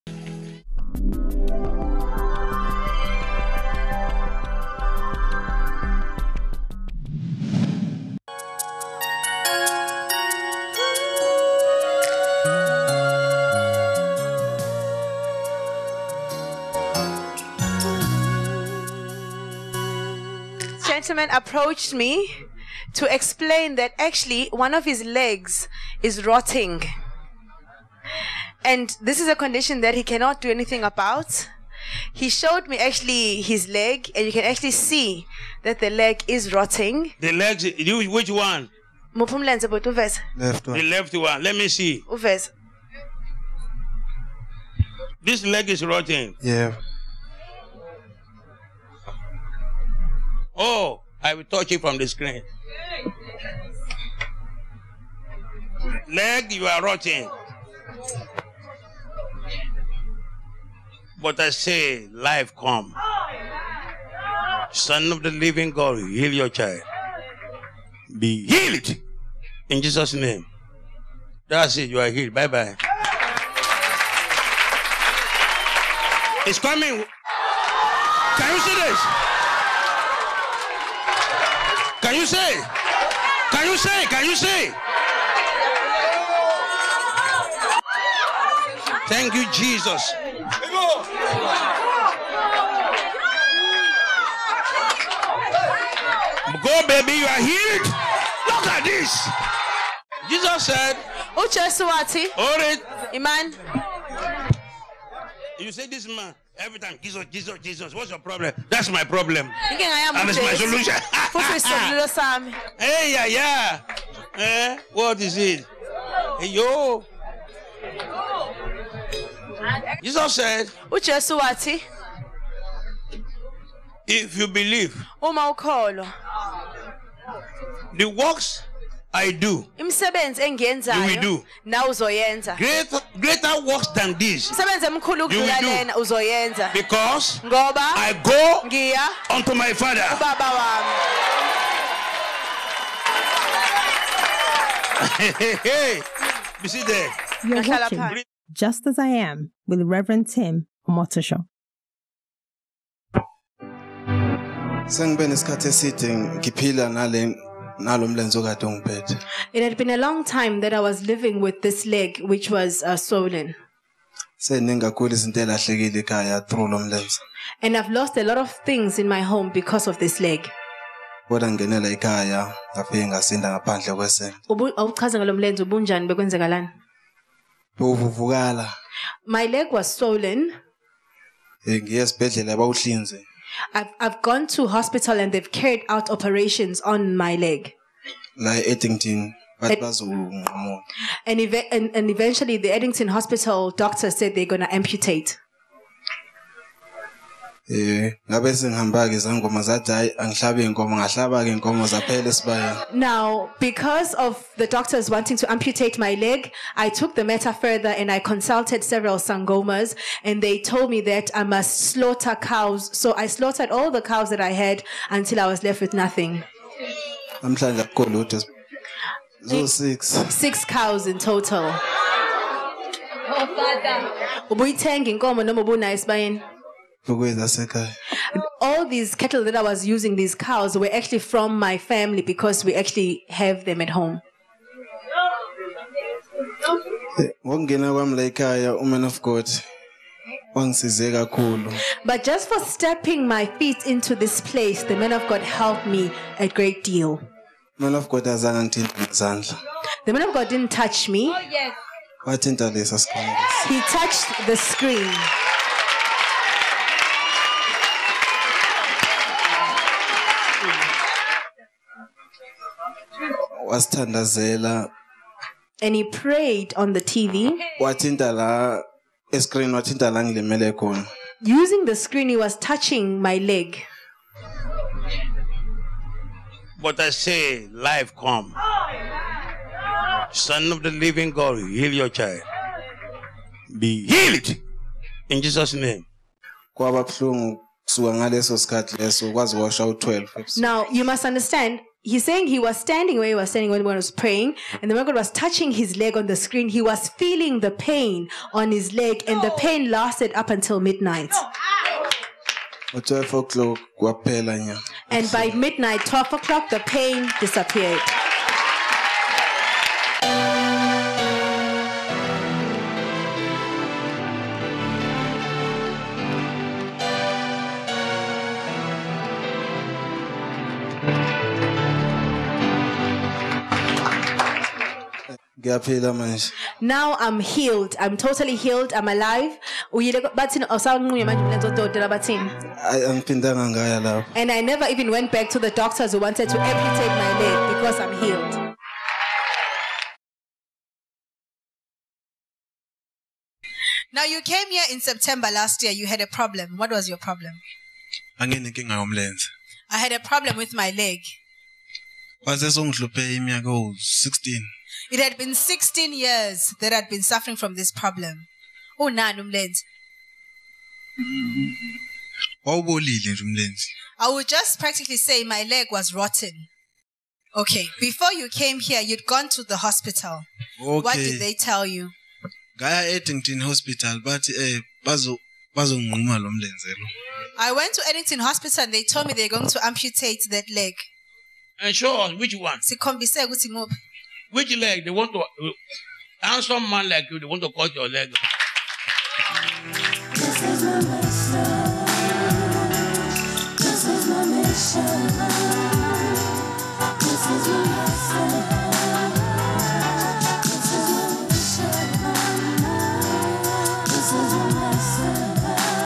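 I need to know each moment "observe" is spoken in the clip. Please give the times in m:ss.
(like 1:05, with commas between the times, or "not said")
not said.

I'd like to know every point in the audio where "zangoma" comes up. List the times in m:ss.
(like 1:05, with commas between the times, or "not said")
3:19.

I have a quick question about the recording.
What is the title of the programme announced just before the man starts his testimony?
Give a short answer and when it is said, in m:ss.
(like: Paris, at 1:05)
Just As I Am, at 2:28.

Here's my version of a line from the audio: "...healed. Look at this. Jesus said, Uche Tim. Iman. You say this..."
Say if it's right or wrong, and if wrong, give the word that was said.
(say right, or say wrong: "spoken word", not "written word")
wrong: "Suwati", not "Tim".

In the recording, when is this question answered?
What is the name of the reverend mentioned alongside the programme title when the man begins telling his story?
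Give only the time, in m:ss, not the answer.
2:30.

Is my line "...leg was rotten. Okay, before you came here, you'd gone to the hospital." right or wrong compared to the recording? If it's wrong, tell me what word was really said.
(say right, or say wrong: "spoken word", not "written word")
right.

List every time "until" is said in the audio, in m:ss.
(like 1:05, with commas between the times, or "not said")
3:35, 5:00.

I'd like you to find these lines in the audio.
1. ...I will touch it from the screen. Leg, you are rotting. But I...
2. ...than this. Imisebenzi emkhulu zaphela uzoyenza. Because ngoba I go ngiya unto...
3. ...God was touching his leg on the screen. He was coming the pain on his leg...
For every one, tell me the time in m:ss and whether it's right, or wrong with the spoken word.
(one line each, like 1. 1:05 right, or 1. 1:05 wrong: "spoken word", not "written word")
1. 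0:51 right
2. 2:13 wrong: "ukudlula", not "zaphela"
3. 4:55 wrong: "feeling", not "coming".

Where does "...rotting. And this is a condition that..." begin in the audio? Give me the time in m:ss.
0:26.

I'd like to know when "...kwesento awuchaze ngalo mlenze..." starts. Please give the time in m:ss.
2:53.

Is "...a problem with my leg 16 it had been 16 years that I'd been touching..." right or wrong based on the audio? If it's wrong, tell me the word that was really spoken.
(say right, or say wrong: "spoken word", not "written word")
wrong: "suffering", not "touching".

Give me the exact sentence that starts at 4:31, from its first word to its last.
Using the screen, he was touching my leg.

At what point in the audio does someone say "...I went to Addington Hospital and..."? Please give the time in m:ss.
6:17.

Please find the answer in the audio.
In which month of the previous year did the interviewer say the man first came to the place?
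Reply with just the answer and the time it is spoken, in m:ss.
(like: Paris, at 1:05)
September, at 5:44.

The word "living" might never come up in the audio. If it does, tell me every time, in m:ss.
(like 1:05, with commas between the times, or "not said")
1:05, 2:41, 4:40.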